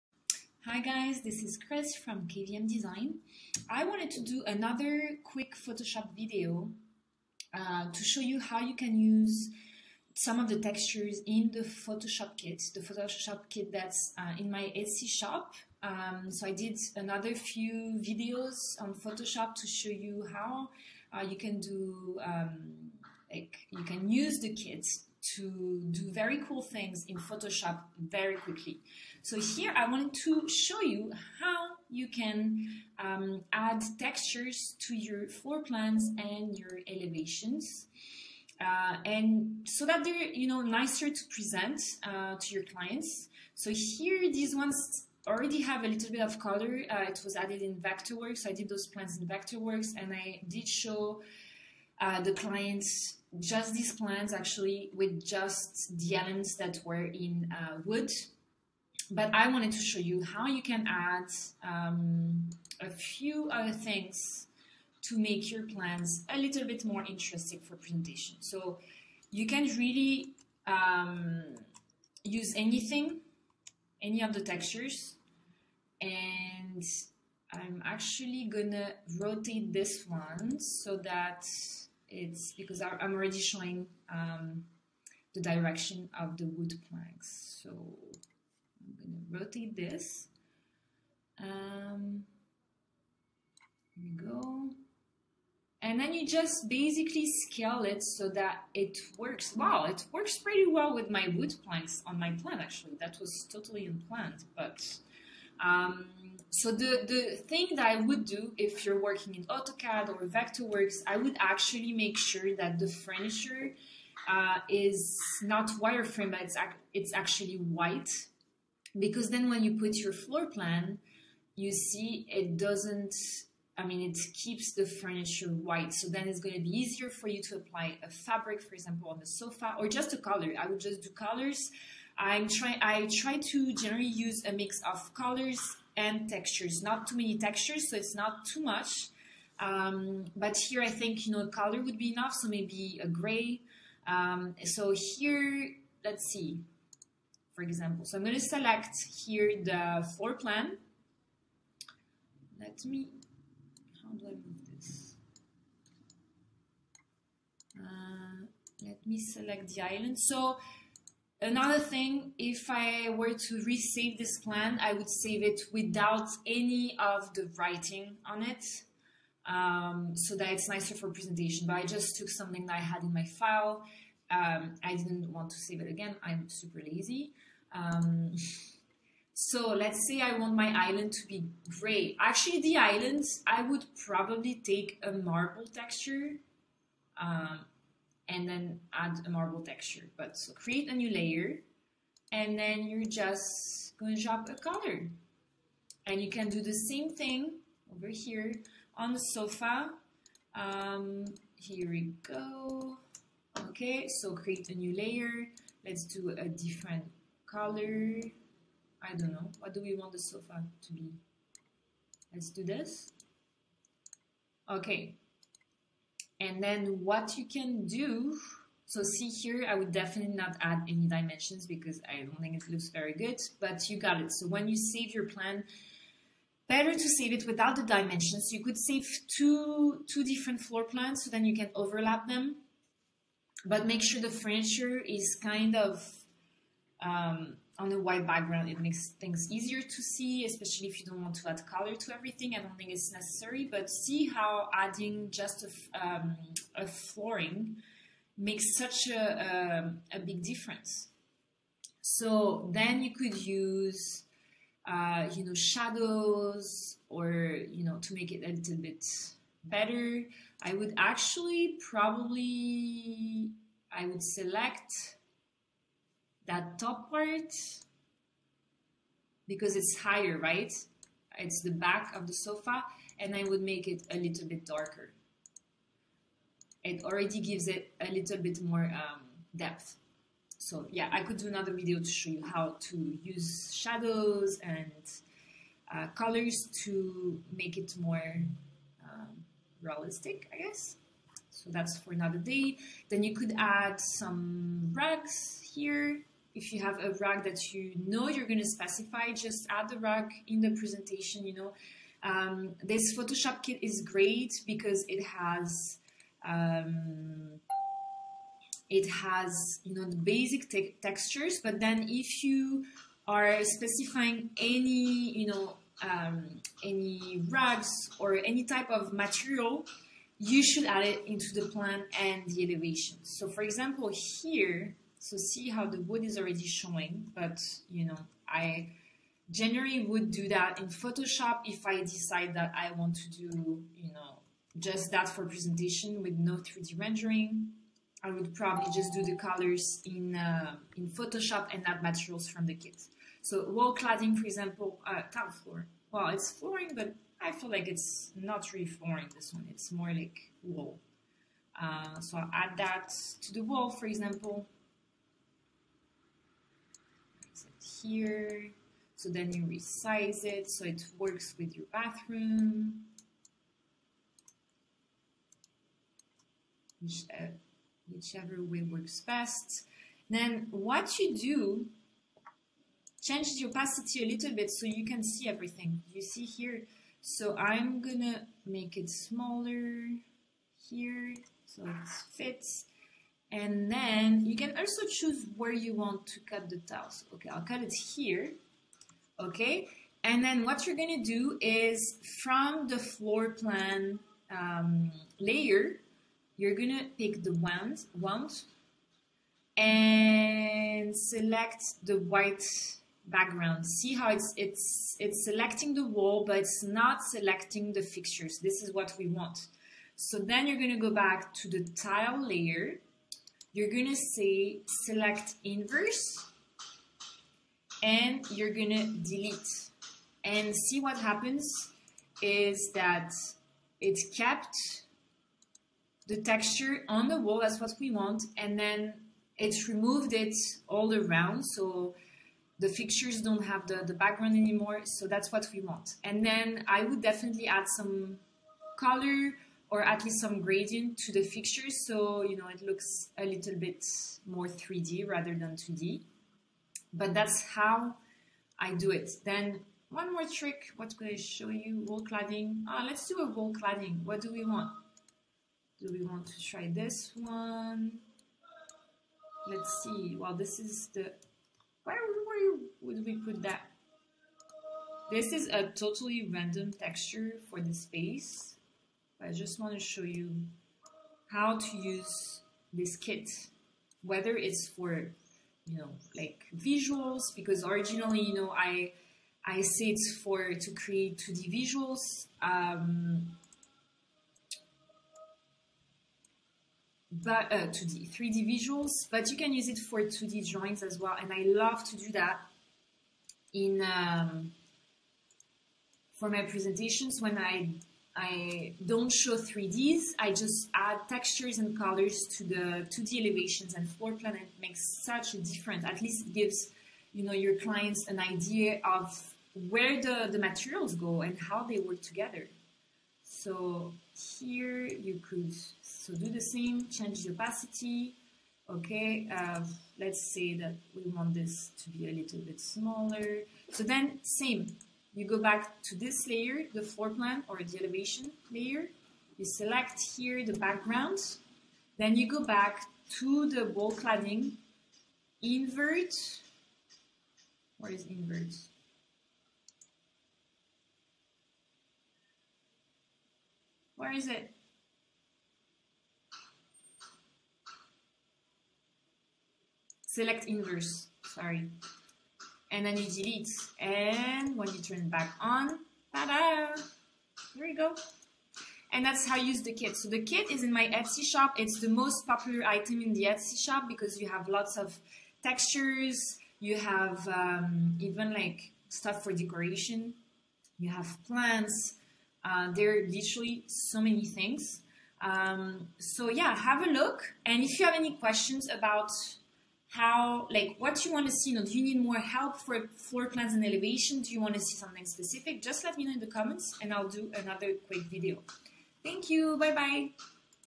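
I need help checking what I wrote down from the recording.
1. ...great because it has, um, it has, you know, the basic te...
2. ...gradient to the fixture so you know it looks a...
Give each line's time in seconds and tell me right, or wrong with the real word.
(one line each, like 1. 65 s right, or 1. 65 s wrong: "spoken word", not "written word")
1. 304 s right
2. 440 s right.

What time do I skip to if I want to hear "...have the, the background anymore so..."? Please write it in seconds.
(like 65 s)
433 s.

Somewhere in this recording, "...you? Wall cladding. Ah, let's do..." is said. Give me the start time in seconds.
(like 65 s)
451 s.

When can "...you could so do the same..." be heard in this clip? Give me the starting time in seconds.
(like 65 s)
515 s.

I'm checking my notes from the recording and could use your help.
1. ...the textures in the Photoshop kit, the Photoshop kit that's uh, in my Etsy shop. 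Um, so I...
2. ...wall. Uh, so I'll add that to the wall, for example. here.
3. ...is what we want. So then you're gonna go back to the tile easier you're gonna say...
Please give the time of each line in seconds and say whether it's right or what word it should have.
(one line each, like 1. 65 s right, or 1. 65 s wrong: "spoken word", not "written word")
1. 10 s right
2. 350 s right
3. 408 s wrong: "layer", not "easier".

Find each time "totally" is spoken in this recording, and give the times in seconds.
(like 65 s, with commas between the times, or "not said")
103 s, 465 s.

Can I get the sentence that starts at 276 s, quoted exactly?
It already gives it a little bit more um, depth.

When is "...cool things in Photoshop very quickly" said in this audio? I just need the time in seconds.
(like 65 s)
26 s.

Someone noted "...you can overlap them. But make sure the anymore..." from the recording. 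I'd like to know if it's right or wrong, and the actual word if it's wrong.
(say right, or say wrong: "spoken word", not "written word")
wrong: "furniture", not "anymore".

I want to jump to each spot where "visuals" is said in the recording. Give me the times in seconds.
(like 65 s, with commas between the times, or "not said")
476 s, 481 s, 488 s.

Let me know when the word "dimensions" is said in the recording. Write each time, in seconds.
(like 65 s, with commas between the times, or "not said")
221 s, 227 s.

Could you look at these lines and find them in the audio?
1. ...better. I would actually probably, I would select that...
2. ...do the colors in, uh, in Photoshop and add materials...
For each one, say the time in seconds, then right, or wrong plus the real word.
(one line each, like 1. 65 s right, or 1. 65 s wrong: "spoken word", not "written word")
1. 259 s right
2. 339 s right.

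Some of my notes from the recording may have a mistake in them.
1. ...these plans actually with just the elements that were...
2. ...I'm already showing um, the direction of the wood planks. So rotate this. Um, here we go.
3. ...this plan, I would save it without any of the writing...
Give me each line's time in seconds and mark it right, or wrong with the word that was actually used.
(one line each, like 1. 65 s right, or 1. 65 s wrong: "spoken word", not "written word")
1. 53 s right
2. 82 s right
3. 164 s right.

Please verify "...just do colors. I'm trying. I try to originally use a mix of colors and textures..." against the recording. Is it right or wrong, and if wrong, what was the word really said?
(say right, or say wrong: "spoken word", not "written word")
wrong: "generally", not "originally".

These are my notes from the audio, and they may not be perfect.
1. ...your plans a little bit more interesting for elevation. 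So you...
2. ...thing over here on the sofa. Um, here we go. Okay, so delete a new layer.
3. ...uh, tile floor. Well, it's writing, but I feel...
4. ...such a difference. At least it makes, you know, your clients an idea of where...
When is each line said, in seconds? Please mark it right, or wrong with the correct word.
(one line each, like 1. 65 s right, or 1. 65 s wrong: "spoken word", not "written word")
1. 65 s wrong: "presentation", not "elevation"
2. 197 s wrong: "create", not "delete"
3. 345 s wrong: "flooring", not "writing"
4. 505 s wrong: "gives", not "makes".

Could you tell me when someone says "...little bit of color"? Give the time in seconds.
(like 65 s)
45 s.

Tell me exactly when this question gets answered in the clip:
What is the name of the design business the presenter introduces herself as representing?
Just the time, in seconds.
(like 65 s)
2 s.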